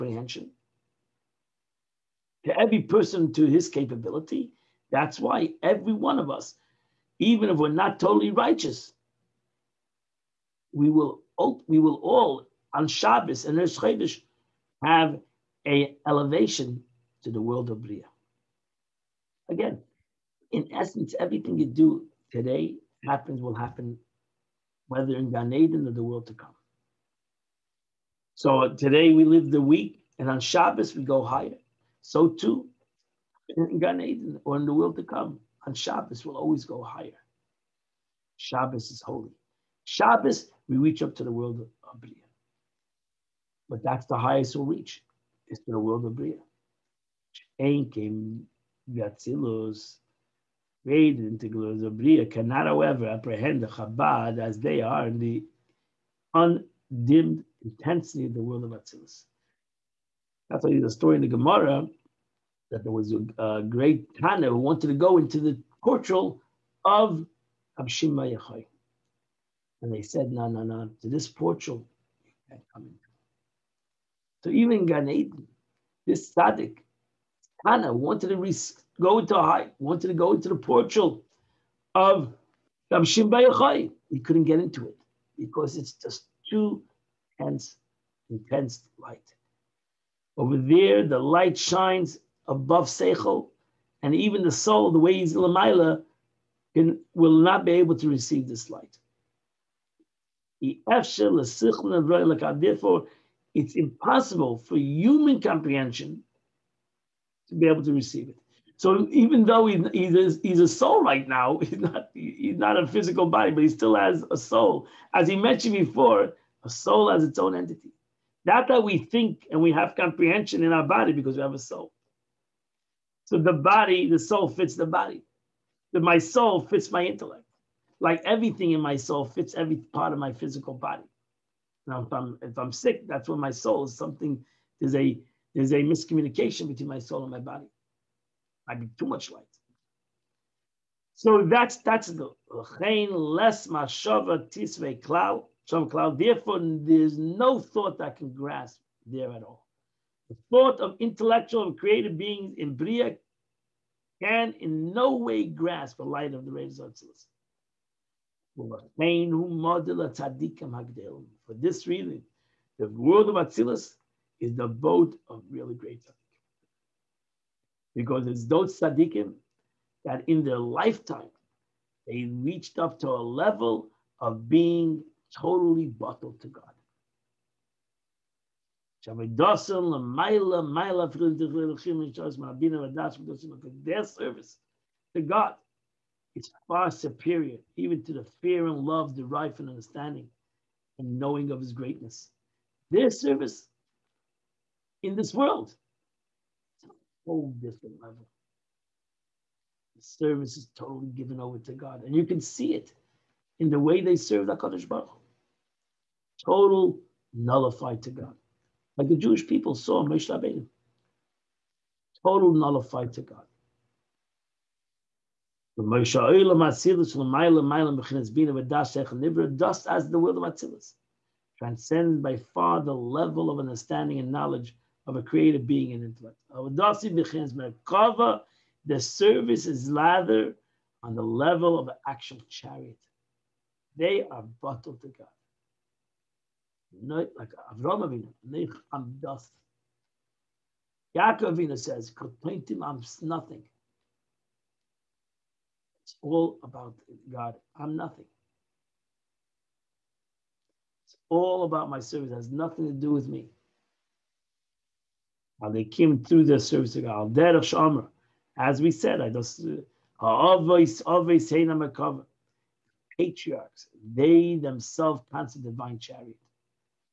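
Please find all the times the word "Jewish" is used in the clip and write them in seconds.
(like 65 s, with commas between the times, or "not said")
209 s.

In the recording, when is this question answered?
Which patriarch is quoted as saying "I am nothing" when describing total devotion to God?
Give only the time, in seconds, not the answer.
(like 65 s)
241 s.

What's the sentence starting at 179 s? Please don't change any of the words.
Their service to God is far superior even to the fear and love derived from understanding and knowing of his greatness.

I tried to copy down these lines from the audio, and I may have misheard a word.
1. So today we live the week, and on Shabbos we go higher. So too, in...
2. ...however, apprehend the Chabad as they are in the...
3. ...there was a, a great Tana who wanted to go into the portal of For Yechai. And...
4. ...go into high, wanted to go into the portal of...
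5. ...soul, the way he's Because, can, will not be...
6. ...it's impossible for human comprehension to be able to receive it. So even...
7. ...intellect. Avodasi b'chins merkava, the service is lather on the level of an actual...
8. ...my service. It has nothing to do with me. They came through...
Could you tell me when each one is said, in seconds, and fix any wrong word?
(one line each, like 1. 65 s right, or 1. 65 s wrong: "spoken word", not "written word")
1. 28 s right
2. 52 s right
3. 62 s wrong: "Abshima", not "For"
4. 78 s right
5. 94 s wrong: "Lamaila", not "Because"
6. 103 s right
7. 226 s right
8. 251 s right.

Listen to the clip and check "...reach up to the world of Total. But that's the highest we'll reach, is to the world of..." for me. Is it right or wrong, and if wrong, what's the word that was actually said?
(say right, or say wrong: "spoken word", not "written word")
wrong: "Bria", not "Total".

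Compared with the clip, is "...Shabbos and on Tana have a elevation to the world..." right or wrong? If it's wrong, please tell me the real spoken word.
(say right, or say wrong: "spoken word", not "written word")
wrong: "Chodesh", not "Tana".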